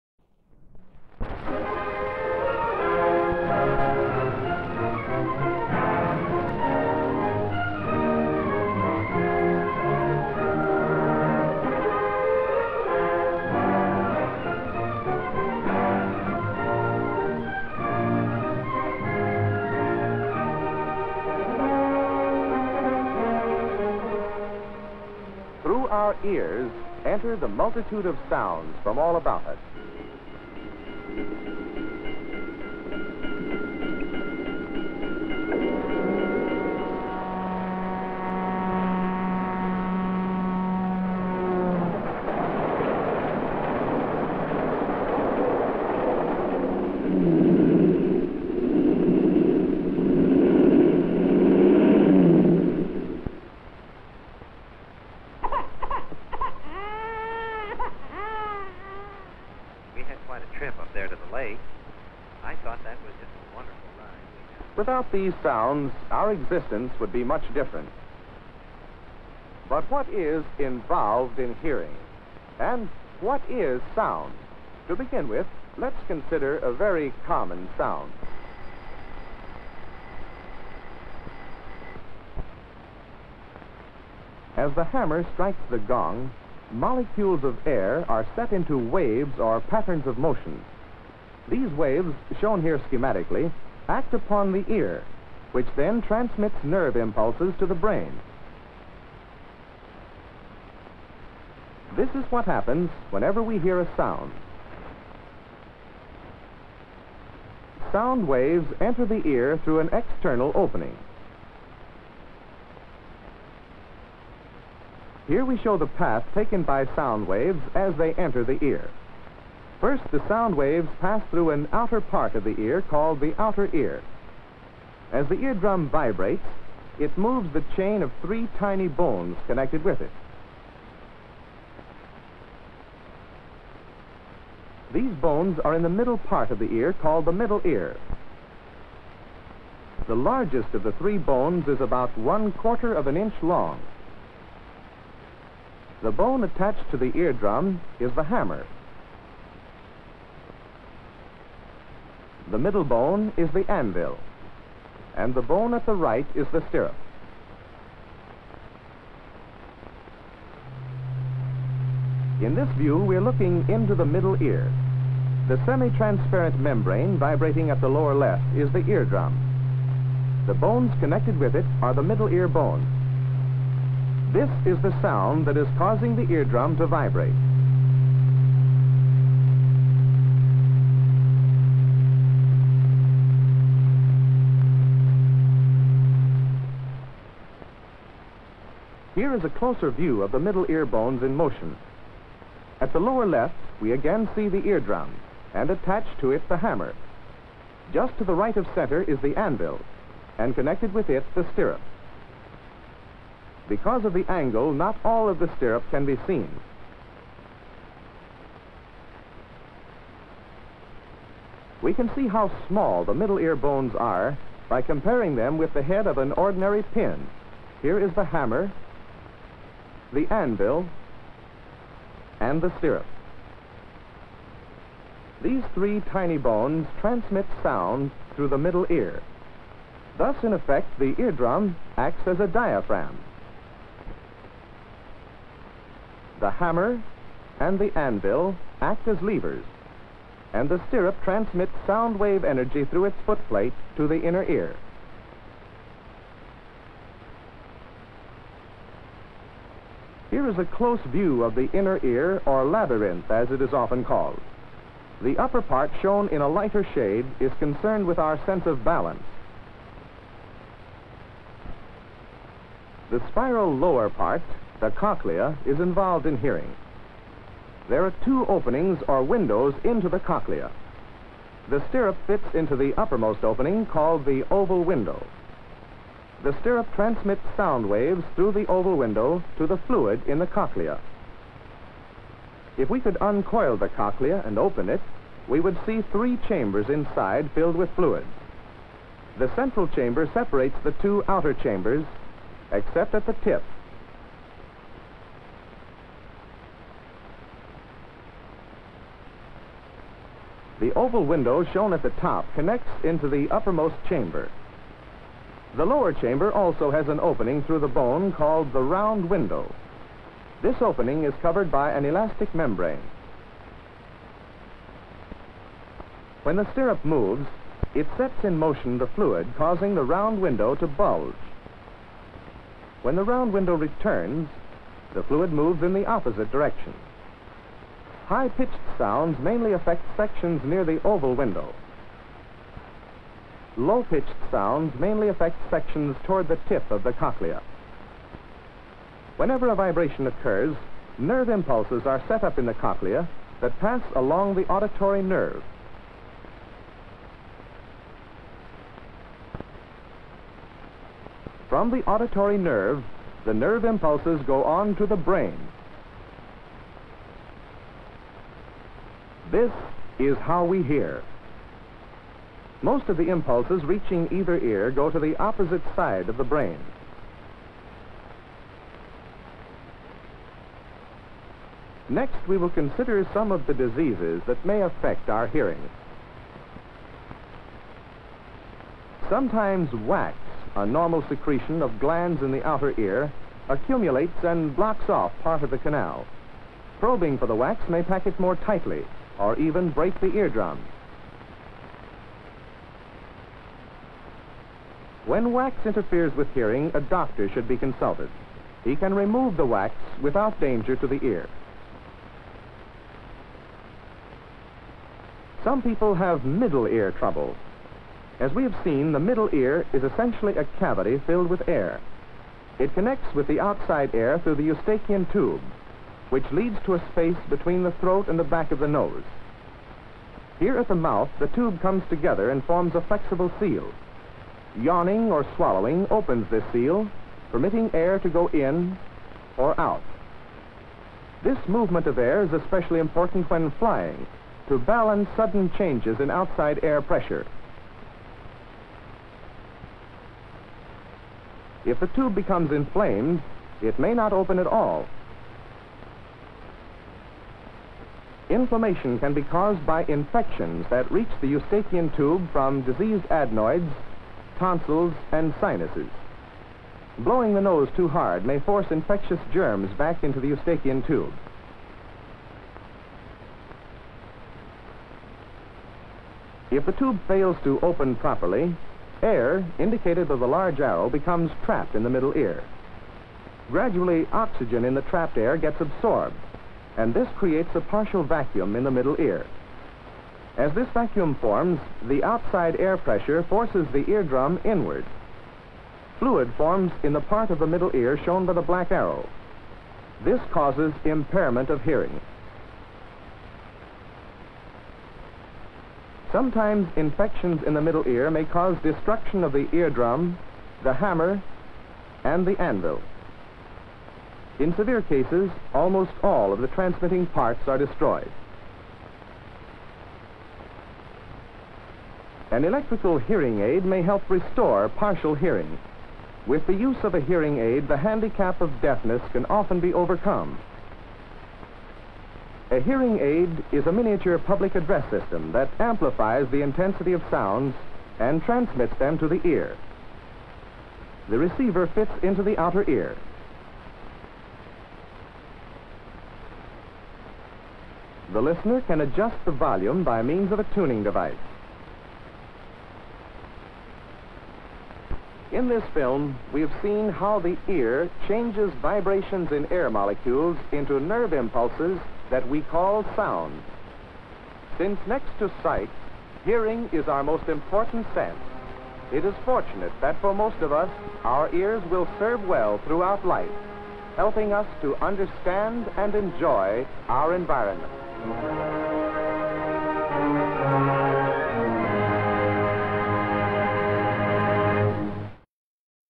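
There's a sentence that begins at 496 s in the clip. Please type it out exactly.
Sometimes infections in the middle ear may cause destruction of the eardrum, the hammer, and the anvil.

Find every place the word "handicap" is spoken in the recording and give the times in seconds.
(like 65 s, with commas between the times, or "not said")
517 s.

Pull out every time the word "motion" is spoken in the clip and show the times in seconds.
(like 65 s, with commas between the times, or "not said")
90 s, 191 s, 318 s.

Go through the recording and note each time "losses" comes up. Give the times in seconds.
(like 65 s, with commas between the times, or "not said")
not said.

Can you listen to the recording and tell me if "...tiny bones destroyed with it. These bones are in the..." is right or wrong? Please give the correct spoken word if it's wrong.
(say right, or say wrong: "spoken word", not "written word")
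wrong: "connected", not "destroyed".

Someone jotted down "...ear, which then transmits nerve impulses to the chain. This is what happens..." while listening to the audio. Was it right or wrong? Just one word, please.
wrong.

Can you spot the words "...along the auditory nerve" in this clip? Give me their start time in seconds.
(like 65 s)
344 s.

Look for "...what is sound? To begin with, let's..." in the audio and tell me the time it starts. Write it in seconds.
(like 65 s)
73 s.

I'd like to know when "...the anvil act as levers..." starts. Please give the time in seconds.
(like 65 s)
237 s.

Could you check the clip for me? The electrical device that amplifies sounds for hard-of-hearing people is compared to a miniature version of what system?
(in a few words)
public address system.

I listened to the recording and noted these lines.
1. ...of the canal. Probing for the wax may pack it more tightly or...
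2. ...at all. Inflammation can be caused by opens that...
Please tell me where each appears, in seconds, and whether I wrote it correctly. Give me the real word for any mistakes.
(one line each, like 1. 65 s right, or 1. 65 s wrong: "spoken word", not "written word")
1. 385 s right
2. 444 s wrong: "infections", not "opens".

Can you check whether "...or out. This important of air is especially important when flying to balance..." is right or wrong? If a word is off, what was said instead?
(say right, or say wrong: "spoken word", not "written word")
wrong: "movement", not "important".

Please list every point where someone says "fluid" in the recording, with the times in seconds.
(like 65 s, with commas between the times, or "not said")
279 s, 287 s, 319 s, 325 s, 486 s.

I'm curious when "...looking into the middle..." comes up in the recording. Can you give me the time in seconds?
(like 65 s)
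163 s.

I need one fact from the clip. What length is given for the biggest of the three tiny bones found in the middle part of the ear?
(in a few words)
1/4 inch.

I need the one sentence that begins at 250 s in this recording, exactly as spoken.
is a close view of the inner ear, or labyrinth as it is often called.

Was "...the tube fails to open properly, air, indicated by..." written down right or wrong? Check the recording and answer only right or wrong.
right.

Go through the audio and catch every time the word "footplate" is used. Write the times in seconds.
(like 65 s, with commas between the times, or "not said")
243 s.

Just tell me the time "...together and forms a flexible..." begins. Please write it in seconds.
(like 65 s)
422 s.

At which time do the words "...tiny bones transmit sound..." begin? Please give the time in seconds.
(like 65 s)
226 s.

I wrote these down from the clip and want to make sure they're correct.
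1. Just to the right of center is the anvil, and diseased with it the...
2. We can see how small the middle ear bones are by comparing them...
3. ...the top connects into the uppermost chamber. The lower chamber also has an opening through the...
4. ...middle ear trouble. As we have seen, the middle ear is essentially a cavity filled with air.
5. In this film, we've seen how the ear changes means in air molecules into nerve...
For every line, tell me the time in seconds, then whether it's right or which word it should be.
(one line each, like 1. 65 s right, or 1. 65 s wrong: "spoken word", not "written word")
1. 197 s wrong: "connected", not "diseased"
2. 211 s right
3. 302 s right
4. 406 s right
5. 545 s wrong: "vibrations", not "means".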